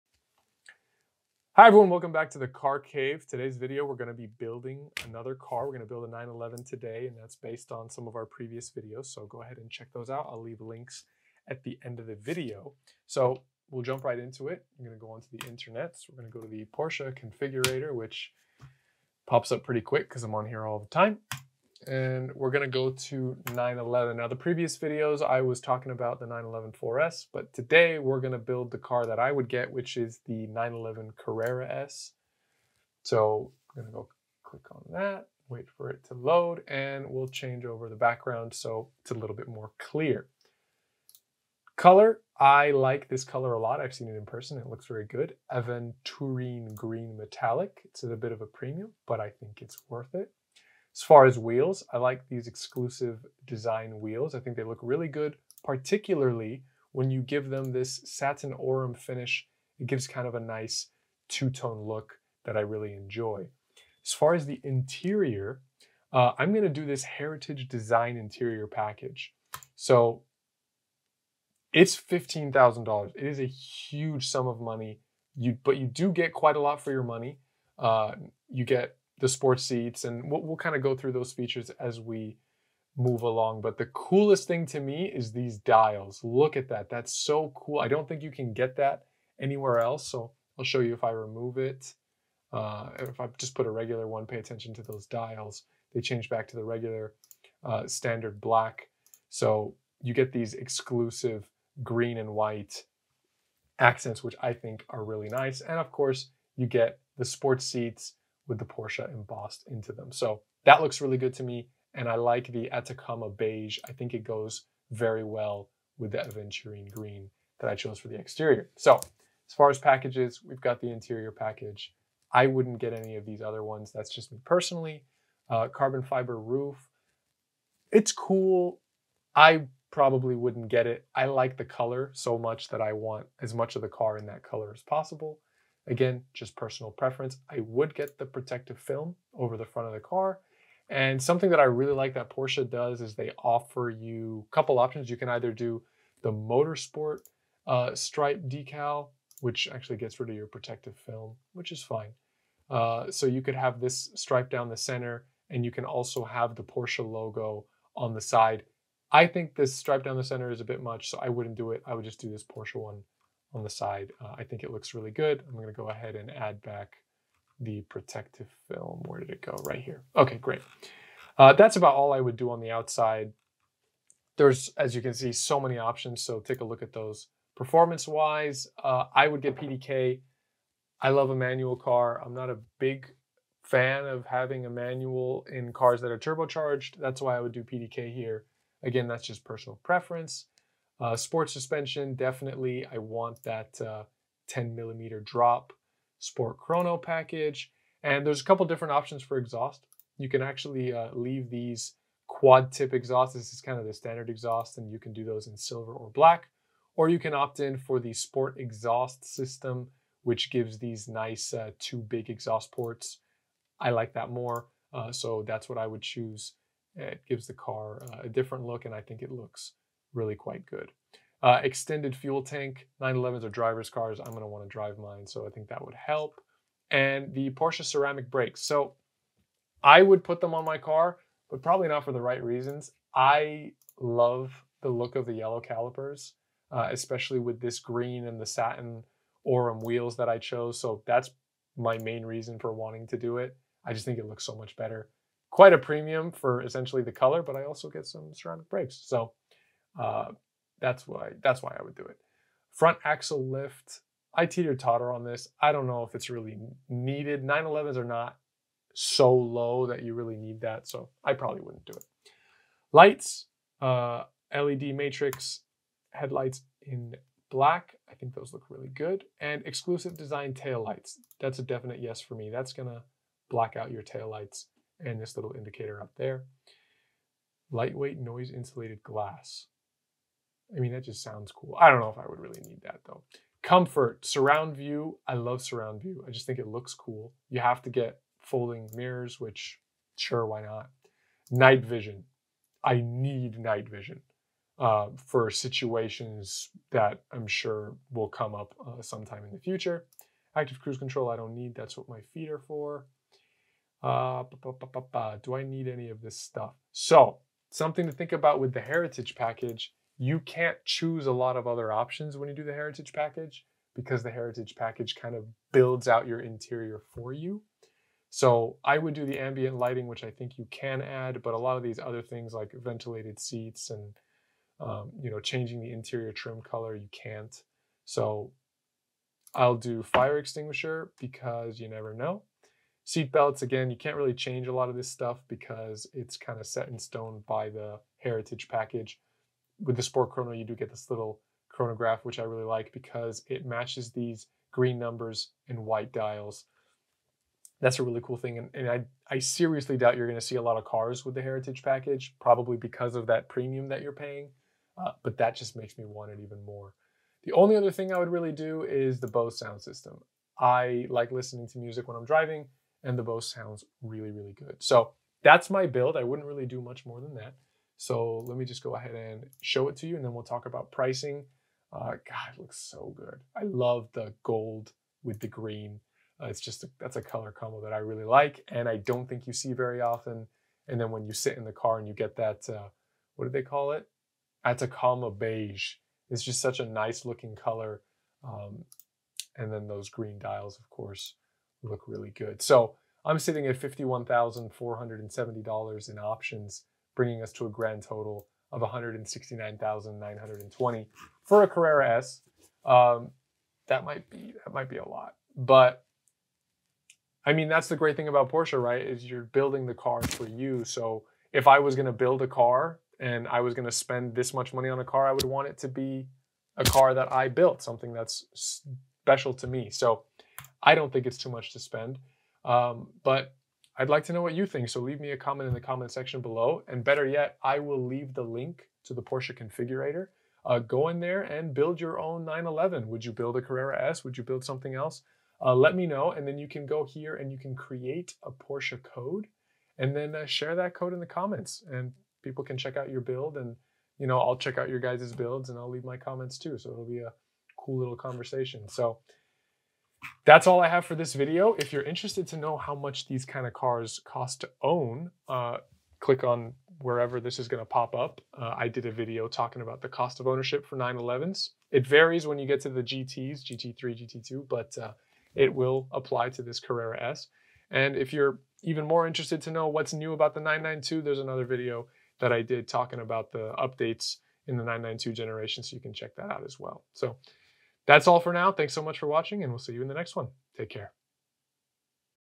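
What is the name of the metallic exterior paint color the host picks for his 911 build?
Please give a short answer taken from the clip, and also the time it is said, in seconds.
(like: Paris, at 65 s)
Aventurine Green Metallic, at 45 s.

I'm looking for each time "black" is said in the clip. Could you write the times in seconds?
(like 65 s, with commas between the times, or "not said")
98 s, 206 s, 267 s, 273 s.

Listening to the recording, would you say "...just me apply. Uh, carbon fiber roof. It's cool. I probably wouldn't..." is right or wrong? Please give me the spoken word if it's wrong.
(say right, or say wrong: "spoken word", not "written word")
wrong: "personally", not "apply".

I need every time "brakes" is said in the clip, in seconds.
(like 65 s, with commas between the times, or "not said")
228 s, 248 s.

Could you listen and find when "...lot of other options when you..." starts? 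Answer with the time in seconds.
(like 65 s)
311 s.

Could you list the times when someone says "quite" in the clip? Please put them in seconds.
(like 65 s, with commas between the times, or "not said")
76 s, 220 s, 245 s.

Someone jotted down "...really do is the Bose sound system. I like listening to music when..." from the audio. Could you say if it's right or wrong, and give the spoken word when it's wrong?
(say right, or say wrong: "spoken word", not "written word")
right.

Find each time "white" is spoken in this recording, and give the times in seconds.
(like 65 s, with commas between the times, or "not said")
102 s, 345 s.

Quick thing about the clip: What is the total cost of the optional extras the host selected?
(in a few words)
$51,470.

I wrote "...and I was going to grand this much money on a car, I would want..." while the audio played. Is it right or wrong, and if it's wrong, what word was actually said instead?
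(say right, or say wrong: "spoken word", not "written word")
wrong: "spend", not "grand".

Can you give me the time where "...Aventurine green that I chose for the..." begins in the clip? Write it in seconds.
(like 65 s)
116 s.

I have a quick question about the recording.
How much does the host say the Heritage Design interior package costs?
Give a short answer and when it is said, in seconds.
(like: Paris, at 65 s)
$15,000, at 71 s.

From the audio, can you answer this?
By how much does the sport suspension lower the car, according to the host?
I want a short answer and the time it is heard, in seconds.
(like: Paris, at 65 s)
10 millimeters, at 194 s.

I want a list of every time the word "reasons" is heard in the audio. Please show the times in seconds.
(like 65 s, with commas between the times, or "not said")
232 s, 242 s.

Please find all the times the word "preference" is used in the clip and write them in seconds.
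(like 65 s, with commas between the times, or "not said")
136 s, 189 s.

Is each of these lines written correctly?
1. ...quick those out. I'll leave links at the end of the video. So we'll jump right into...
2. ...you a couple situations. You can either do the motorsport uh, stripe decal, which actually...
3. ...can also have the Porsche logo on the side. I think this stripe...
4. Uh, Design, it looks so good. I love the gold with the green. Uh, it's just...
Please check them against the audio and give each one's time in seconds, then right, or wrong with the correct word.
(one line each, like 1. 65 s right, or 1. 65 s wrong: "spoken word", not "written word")
1. 9 s wrong: "check", not "quick"
2. 143 s wrong: "options", not "situations"
3. 155 s right
4. 371 s wrong: "God", not "Design".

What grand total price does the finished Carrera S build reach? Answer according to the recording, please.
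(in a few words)
169,920.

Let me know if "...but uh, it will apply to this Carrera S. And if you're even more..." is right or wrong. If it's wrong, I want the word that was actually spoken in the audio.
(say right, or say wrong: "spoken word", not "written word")
right.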